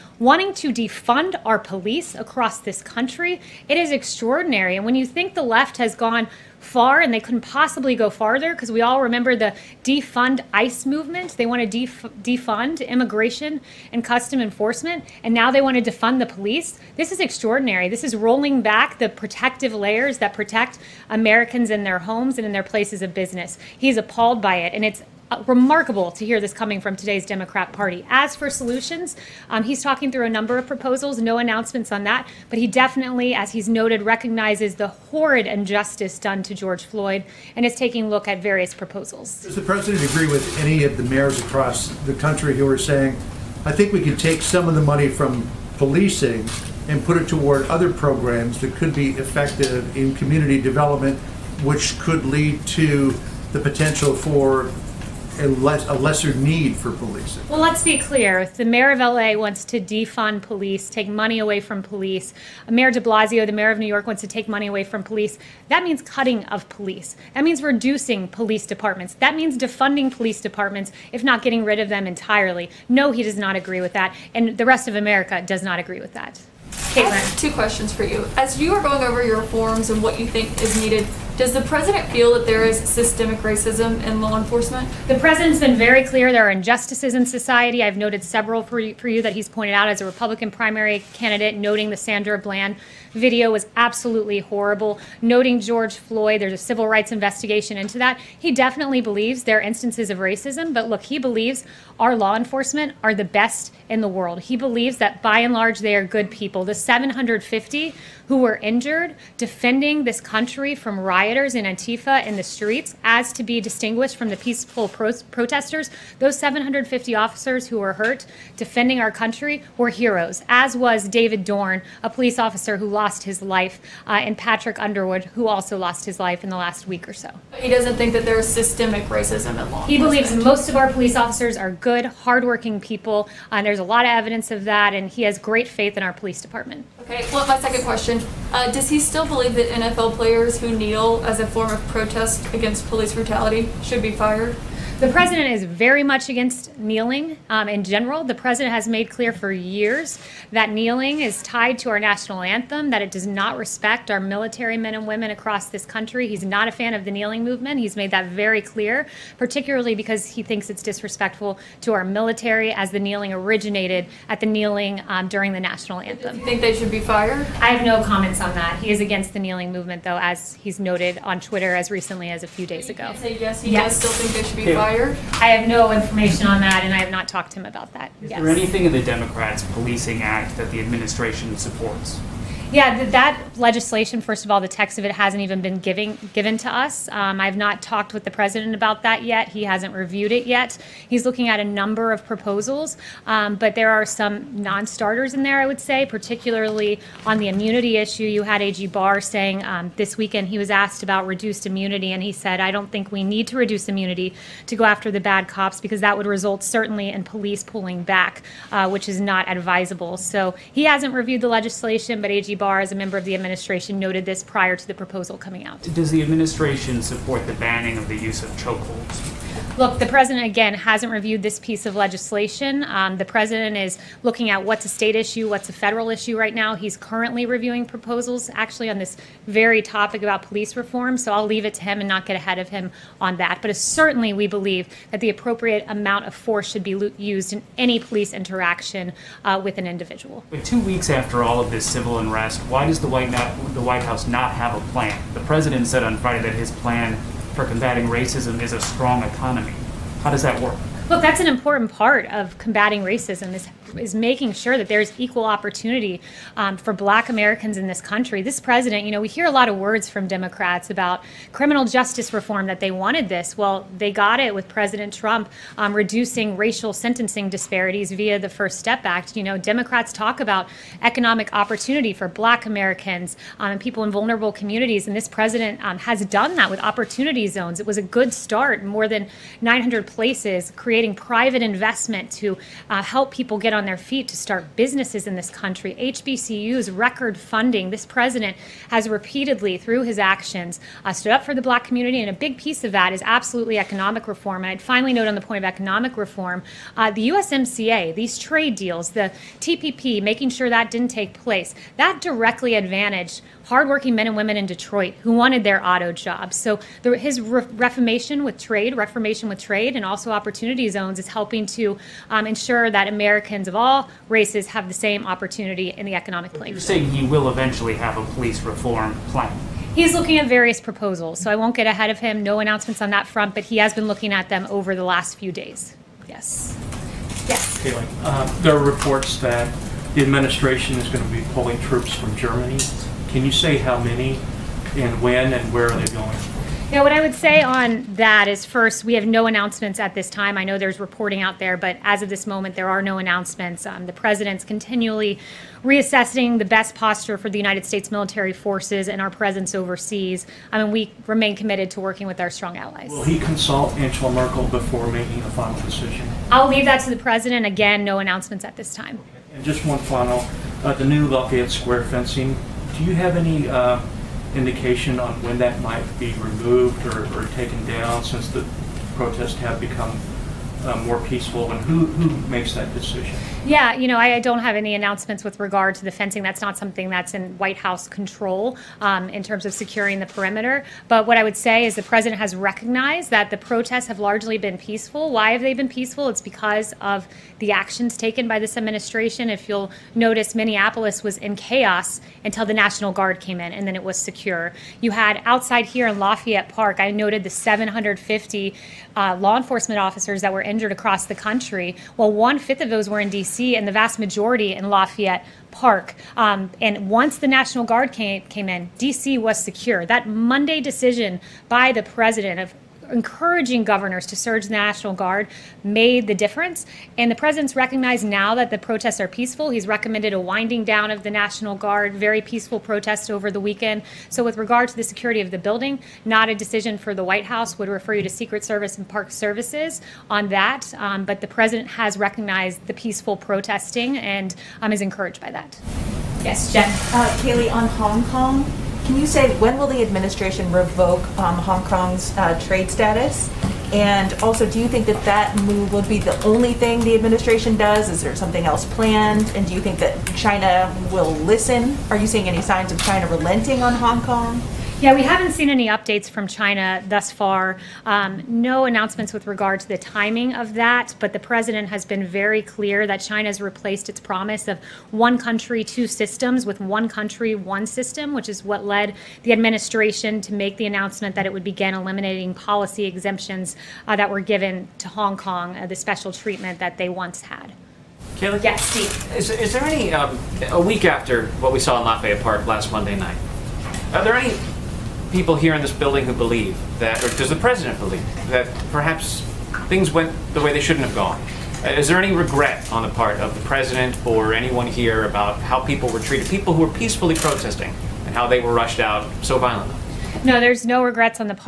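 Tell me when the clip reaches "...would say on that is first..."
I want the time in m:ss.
5:37.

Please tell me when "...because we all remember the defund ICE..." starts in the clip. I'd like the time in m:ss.
0:08.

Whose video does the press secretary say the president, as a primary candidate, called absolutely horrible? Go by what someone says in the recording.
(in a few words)
Sandra Bland.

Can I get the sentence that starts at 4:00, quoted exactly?
But two weeks after all of this civil unrest, why does the White, the White House not have a plan?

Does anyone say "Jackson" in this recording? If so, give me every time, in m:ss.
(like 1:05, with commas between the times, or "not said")
not said.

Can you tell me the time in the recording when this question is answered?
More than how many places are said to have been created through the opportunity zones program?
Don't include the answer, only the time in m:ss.
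4:39.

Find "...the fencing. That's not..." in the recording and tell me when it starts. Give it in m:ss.
6:16.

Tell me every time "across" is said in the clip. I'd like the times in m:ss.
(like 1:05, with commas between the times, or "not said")
0:02, 0:41, 2:35, 6:40.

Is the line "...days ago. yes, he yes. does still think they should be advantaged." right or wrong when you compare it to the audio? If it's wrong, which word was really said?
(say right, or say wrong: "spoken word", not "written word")
wrong: "fired", not "advantaged".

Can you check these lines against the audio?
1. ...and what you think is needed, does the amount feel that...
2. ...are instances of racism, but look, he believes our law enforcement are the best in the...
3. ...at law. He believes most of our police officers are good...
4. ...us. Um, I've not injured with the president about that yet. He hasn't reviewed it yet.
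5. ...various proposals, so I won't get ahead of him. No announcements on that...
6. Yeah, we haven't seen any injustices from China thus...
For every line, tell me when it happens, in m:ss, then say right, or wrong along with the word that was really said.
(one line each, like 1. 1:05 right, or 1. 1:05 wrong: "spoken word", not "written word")
1. 1:19 wrong: "president", not "amount"
2. 1:39 right
3. 2:09 right
4. 3:06 wrong: "talked", not "injured"
5. 5:20 right
6. 7:34 wrong: "updates", not "injustices".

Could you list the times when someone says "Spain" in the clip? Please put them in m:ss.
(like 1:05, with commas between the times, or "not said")
not said.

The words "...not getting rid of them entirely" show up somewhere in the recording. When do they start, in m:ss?
1:11.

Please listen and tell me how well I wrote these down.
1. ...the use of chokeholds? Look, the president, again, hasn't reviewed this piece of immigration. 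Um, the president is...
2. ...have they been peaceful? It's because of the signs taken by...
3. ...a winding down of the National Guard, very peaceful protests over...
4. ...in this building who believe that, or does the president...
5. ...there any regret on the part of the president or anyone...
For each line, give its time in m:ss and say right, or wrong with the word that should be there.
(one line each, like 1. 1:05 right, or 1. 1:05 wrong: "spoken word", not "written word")
1. 3:38 wrong: "legislation", not "immigration"
2. 6:25 wrong: "actions", not "signs"
3. 7:00 right
4. 8:05 right
5. 8:12 right.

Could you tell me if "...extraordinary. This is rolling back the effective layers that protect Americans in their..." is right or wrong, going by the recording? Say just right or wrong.
wrong.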